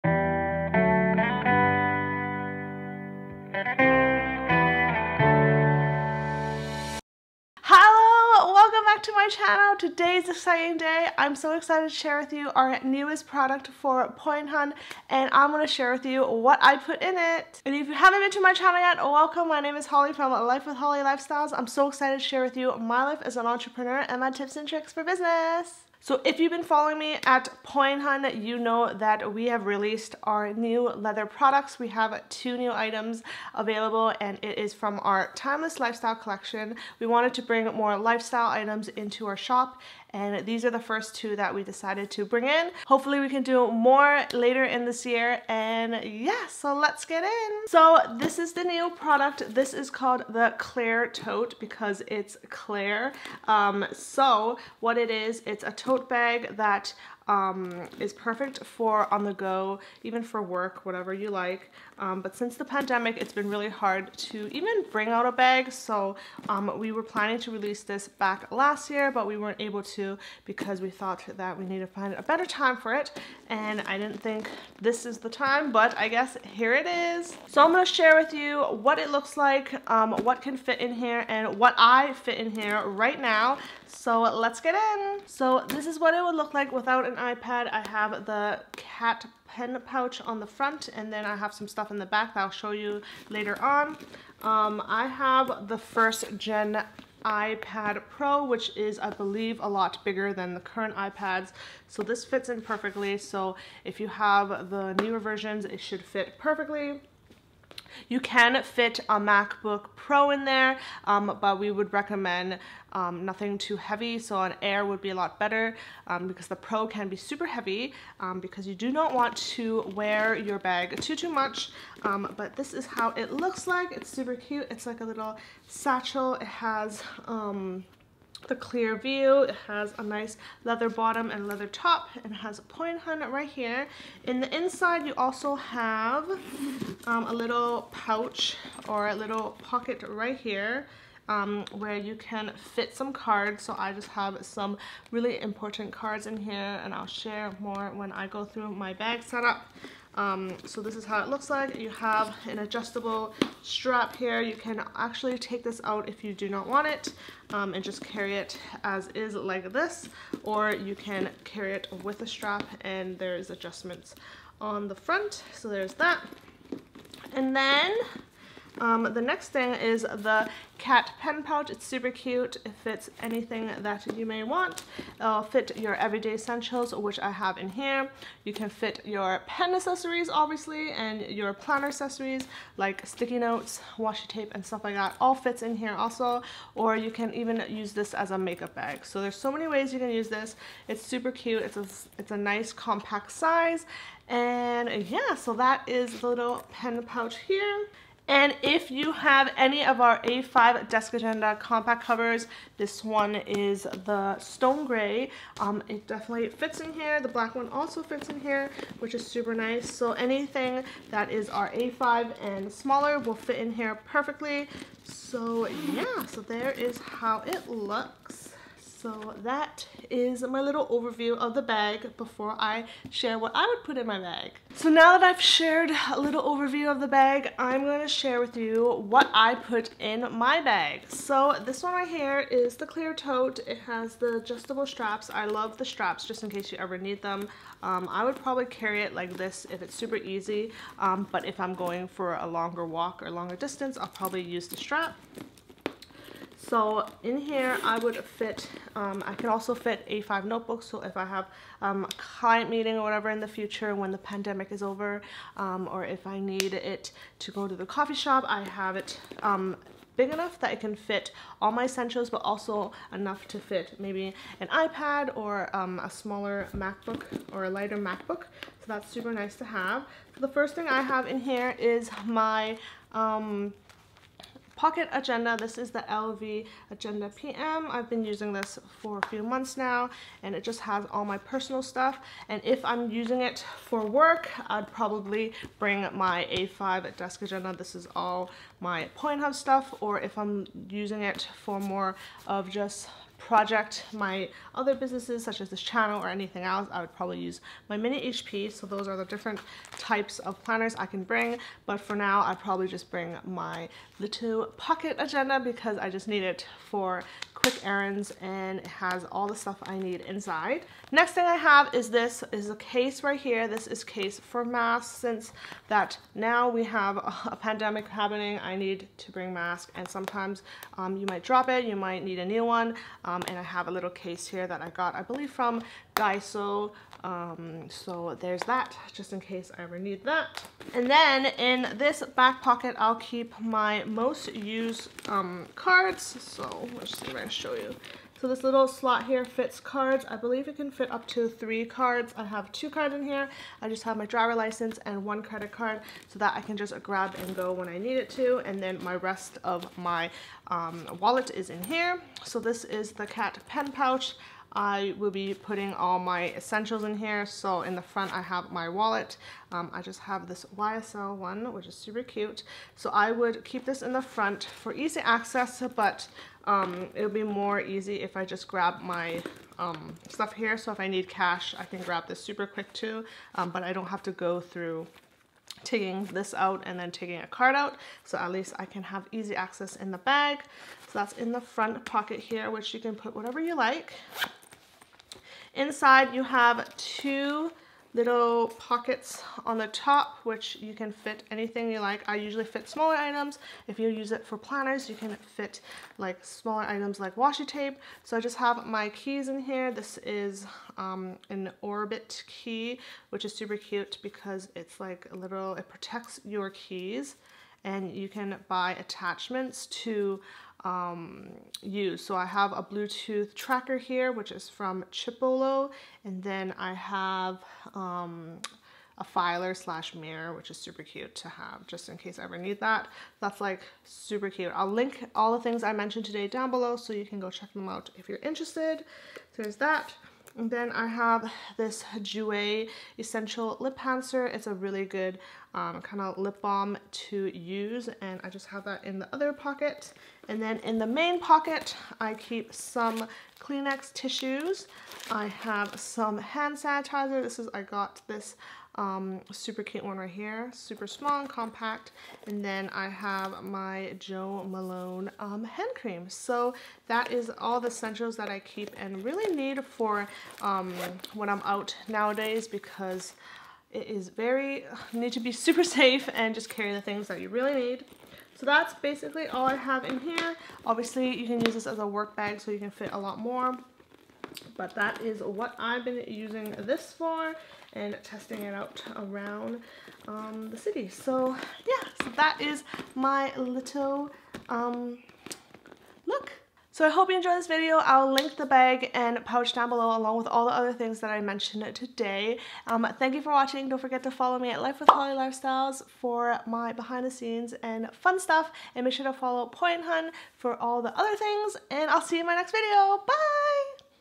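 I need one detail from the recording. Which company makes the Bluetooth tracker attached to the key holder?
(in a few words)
Chipolo.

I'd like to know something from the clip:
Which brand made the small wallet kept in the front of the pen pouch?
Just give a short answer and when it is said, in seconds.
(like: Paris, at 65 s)
YSL, at 360 s.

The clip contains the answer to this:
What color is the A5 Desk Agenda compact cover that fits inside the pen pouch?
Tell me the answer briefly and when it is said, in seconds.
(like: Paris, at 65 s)
Stone gray, at 204 s.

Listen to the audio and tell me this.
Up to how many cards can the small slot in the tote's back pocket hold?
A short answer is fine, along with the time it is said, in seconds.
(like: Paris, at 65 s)
3, at 341 s.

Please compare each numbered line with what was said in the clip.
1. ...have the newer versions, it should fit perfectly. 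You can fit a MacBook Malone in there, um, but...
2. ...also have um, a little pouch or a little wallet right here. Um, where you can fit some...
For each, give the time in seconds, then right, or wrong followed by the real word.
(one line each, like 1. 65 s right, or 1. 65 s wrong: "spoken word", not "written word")
1. 104 s wrong: "Pro", not "Malone"
2. 135 s wrong: "pocket", not "wallet".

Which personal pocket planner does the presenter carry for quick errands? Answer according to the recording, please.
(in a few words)
LV Agenda PM.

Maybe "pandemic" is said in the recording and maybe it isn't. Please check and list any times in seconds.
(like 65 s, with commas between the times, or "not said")
62 s, 254 s, 317 s.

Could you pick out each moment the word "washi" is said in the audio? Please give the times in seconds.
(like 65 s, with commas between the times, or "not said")
183 s, 397 s.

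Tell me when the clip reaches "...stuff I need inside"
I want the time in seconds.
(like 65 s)
309 s.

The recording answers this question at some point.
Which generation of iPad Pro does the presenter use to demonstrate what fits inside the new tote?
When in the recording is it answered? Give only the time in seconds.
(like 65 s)
95 s.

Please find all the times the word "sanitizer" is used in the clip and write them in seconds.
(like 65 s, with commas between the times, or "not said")
446 s.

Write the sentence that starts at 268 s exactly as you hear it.
So that's super nice to have.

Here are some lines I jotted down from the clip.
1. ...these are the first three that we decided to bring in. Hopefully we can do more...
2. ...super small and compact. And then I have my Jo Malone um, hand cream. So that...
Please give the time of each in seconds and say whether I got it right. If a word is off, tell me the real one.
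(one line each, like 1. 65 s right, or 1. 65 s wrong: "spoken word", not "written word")
1. 40 s wrong: "two", not "three"
2. 450 s right.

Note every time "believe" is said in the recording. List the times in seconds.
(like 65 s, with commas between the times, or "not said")
99 s, 325 s, 340 s.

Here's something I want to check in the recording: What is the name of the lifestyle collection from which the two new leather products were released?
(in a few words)
Timeless Lifestyle.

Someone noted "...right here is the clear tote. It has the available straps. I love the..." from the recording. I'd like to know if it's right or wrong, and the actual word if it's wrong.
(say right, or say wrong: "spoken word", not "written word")
wrong: "adjustable", not "available".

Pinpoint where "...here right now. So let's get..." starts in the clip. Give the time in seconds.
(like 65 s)
82 s.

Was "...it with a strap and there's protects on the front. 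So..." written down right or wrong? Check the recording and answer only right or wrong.
wrong.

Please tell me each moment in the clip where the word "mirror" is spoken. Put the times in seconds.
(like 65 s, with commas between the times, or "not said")
420 s.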